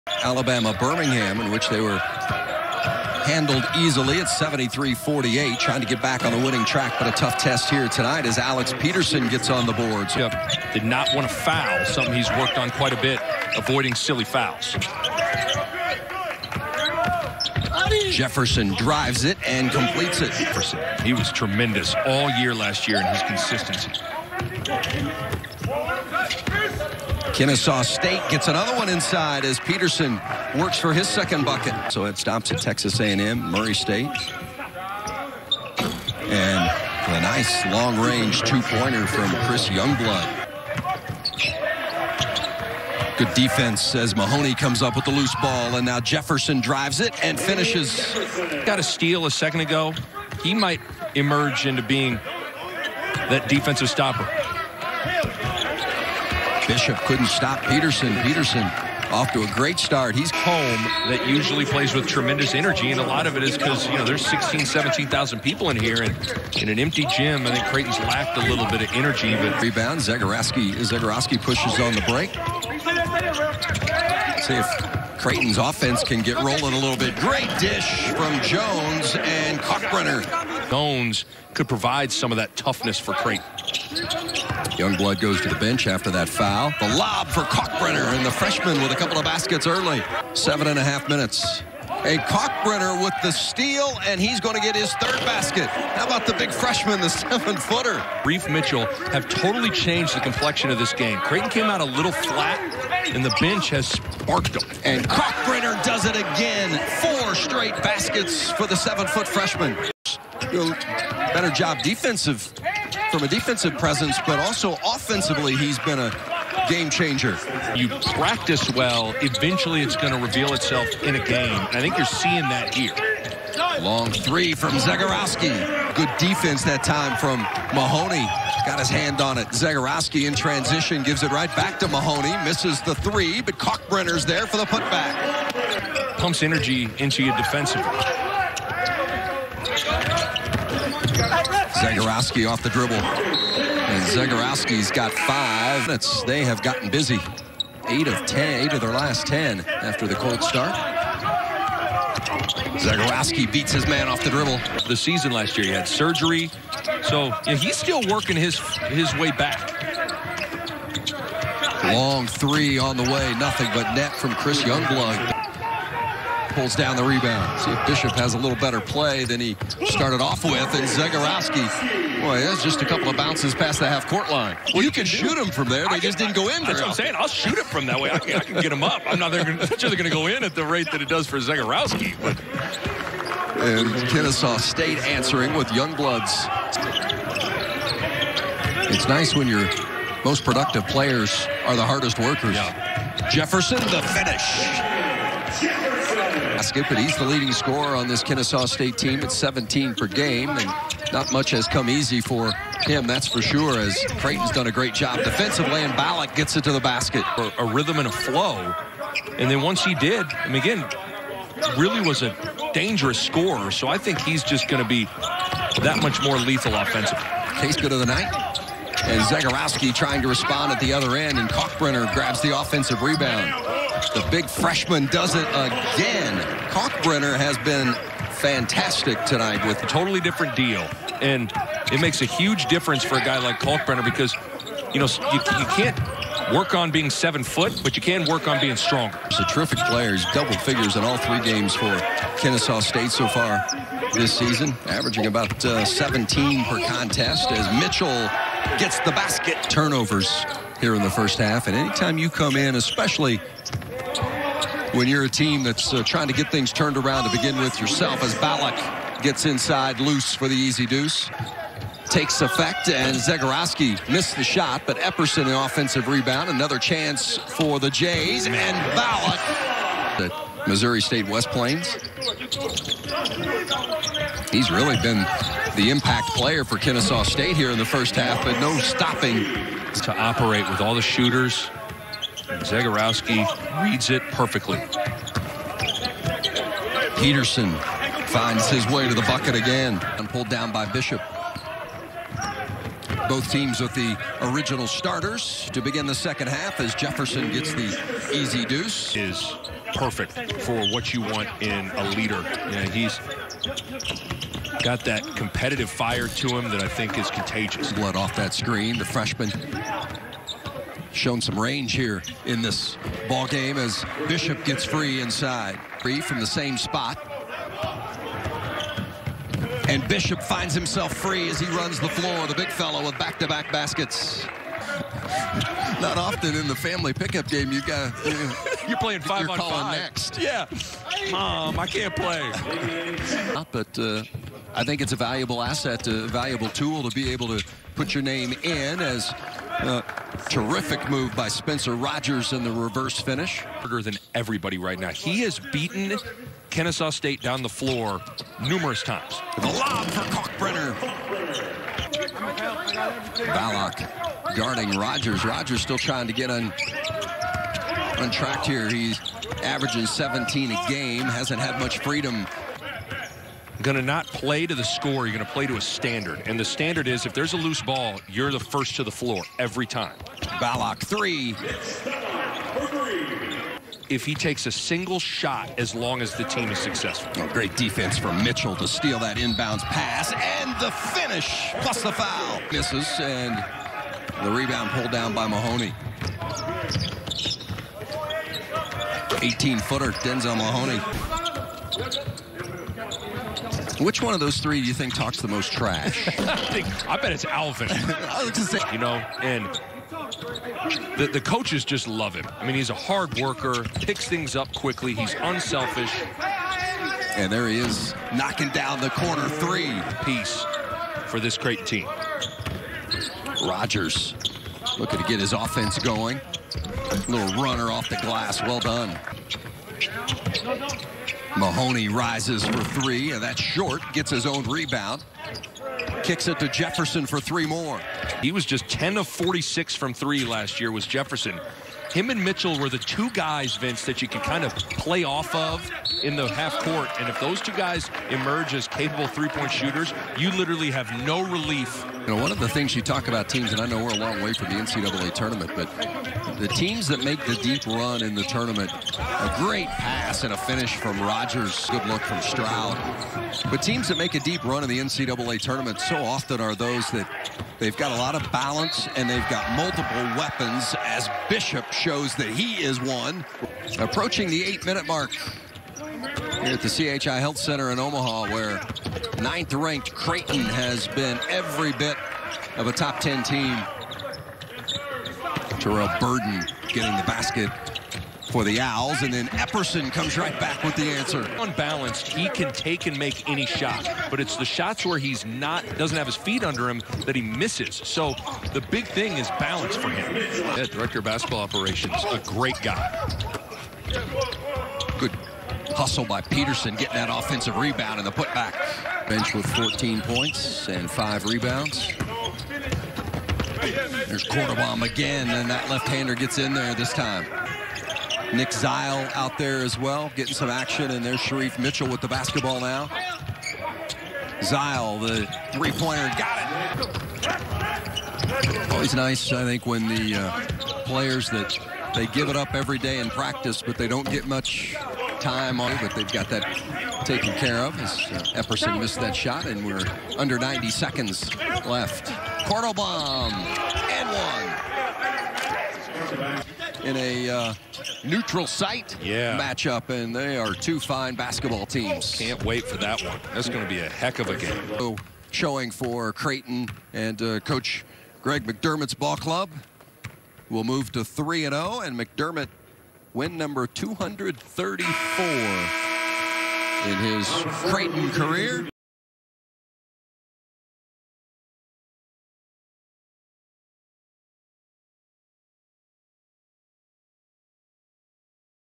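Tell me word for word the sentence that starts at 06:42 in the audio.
I mean, he's a hard worker, picks things up quickly, he's unselfish.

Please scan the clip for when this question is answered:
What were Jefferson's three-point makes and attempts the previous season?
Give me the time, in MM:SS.
07:08.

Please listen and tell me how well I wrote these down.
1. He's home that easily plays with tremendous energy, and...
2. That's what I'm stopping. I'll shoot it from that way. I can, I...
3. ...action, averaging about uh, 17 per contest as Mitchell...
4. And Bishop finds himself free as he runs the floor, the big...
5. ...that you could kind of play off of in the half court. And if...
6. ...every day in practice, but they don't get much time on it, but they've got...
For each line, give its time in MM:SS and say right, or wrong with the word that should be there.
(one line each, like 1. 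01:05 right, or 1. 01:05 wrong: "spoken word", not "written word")
1. 01:00 wrong: "usually", not "easily"
2. 02:56 wrong: "saying", not "stopping"
3. 04:04 wrong: "season", not "action"
4. 05:19 right
5. 07:14 right
6. 08:42 right.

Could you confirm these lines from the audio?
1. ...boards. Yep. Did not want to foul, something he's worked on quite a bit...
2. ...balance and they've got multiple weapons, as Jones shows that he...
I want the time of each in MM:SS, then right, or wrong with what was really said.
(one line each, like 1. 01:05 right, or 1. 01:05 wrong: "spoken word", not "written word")
1. 00:09 right
2. 07:38 wrong: "Bishop", not "Jones".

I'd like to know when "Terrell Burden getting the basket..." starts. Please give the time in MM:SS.
07:55.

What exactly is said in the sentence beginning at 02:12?
Misses the three, but Kalkbrenner's there for the putback.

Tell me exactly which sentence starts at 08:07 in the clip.
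So the big thing is balance for him.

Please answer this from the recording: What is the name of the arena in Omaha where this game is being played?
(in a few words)
CHI Health Center.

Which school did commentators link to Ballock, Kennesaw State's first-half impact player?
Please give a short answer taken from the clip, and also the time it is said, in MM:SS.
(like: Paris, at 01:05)
Missouri State West Plains, at 04:30.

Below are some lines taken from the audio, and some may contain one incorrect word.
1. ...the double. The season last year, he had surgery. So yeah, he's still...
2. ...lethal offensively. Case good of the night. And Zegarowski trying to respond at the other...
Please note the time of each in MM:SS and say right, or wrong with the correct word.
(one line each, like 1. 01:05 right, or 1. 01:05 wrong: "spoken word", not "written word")
1. 02:34 wrong: "dribble", not "double"
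2. 03:36 right.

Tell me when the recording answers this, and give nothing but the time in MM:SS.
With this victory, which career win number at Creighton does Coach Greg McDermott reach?
09:13.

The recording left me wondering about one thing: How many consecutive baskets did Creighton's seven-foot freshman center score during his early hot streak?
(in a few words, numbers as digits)
4.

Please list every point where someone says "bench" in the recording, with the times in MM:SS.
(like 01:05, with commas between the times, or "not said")
01:25, 01:43, 08:19.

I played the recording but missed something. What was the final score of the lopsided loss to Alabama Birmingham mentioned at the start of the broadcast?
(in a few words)
73-48.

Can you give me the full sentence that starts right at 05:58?
He's averaging 17 a game, hasn't had much freedom going to not play to the score.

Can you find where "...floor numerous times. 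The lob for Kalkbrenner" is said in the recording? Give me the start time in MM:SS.
05:47.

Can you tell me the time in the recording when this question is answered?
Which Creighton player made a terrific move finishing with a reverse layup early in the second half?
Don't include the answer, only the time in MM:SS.
05:41.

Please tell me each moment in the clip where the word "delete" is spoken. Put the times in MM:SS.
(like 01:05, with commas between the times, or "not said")
not said.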